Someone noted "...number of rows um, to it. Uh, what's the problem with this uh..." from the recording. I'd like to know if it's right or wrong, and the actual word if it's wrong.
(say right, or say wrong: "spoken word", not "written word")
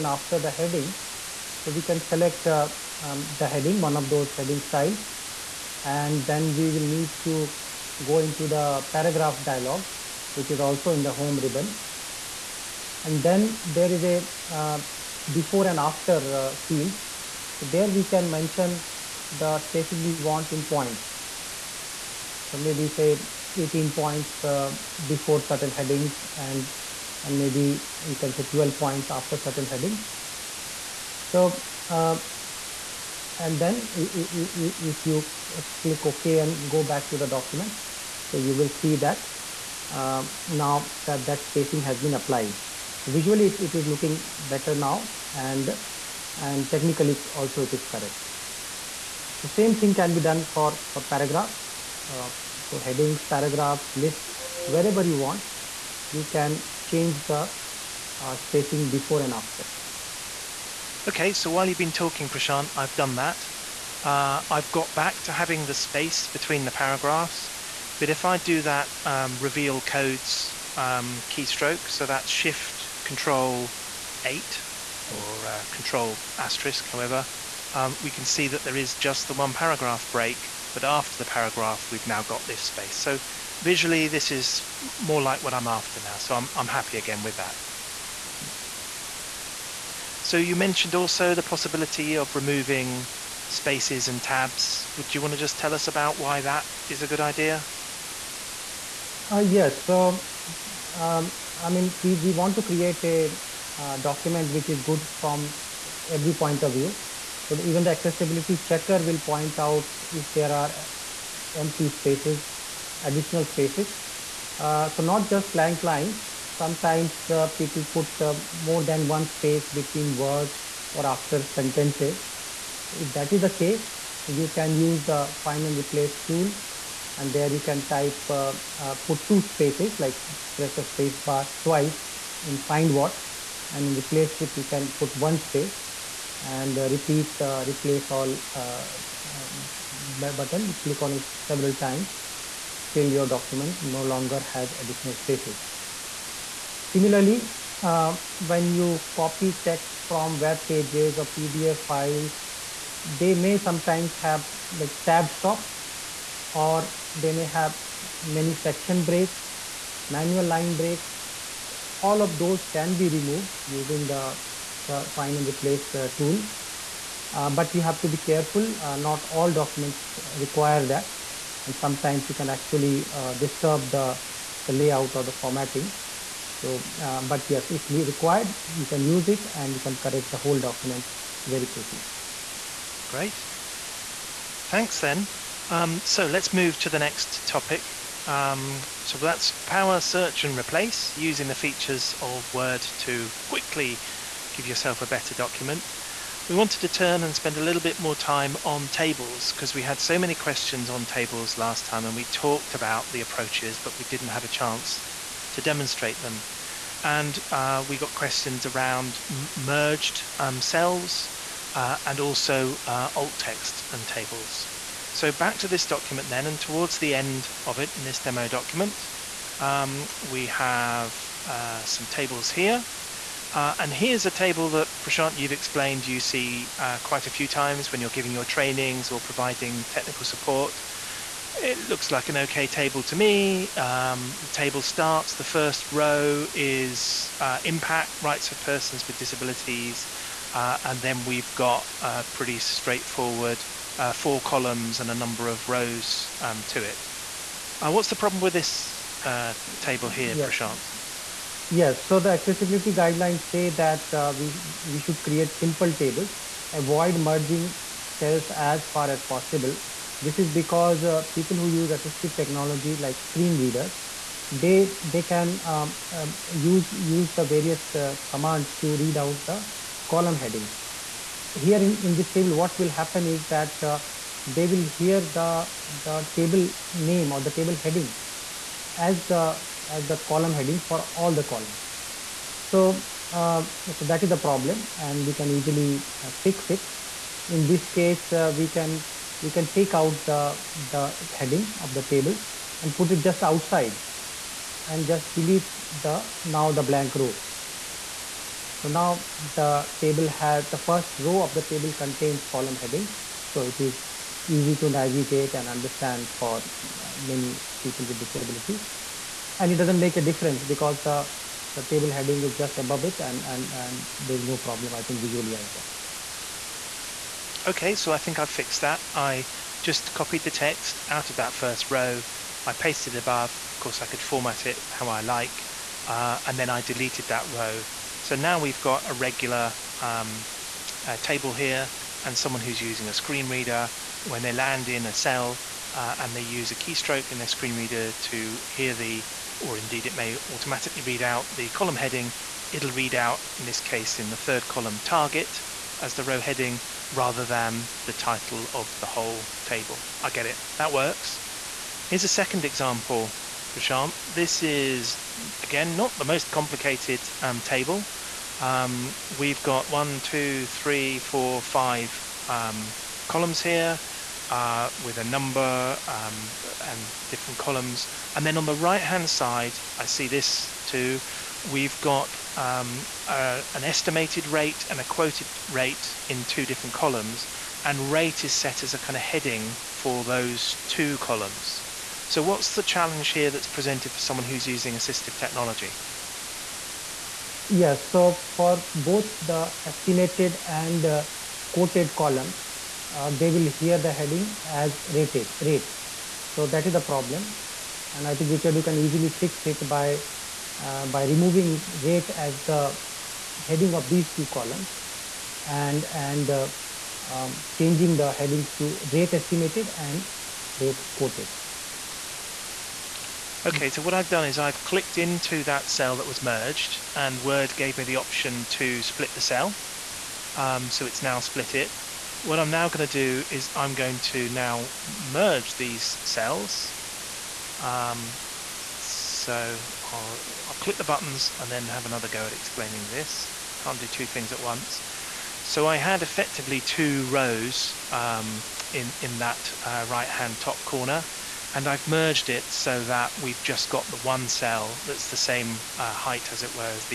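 right.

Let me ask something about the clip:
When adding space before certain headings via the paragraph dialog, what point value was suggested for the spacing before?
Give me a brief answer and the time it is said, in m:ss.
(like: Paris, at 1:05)
18 points, at 0:23.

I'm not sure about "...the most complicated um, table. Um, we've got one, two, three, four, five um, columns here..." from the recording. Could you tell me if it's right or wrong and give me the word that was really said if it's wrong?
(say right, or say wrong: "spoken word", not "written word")
right.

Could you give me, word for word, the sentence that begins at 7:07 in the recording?
Um, so I'll, I'll click the buttons and then have another go at explaining this.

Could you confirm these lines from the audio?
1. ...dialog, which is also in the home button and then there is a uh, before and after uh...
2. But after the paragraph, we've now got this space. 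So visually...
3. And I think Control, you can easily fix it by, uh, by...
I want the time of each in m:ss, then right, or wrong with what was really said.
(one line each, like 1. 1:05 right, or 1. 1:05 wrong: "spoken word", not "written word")
1. 0:09 wrong: "ribbon", not "button"
2. 1:20 right
3. 6:38 wrong: "Richard", not "Control".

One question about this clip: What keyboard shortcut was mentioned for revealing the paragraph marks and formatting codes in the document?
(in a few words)
Shift Control 8.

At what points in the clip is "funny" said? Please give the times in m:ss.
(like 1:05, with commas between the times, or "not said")
not said.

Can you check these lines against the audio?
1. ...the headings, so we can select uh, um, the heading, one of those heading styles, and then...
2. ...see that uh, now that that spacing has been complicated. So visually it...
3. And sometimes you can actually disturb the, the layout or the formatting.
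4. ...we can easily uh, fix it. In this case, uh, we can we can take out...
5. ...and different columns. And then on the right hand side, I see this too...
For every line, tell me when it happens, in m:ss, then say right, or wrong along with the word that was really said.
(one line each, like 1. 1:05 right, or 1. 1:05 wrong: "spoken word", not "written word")
1. 0:00 right
2. 0:38 wrong: "applied", not "complicated"
3. 2:51 right
4. 4:45 right
5. 6:06 right.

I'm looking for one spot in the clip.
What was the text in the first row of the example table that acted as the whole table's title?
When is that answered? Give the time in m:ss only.
3:57.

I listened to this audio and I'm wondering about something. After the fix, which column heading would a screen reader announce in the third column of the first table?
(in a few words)
Target.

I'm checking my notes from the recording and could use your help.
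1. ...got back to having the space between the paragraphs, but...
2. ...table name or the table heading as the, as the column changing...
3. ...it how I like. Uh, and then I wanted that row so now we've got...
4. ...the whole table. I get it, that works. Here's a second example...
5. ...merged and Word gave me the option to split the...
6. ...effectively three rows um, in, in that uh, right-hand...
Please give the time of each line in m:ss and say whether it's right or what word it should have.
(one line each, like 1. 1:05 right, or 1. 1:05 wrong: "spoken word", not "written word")
1. 1:04 right
2. 4:36 wrong: "heading", not "changing"
3. 5:24 wrong: "deleted", not "wanted"
4. 5:49 right
5. 6:56 right
6. 7:16 wrong: "two", not "three".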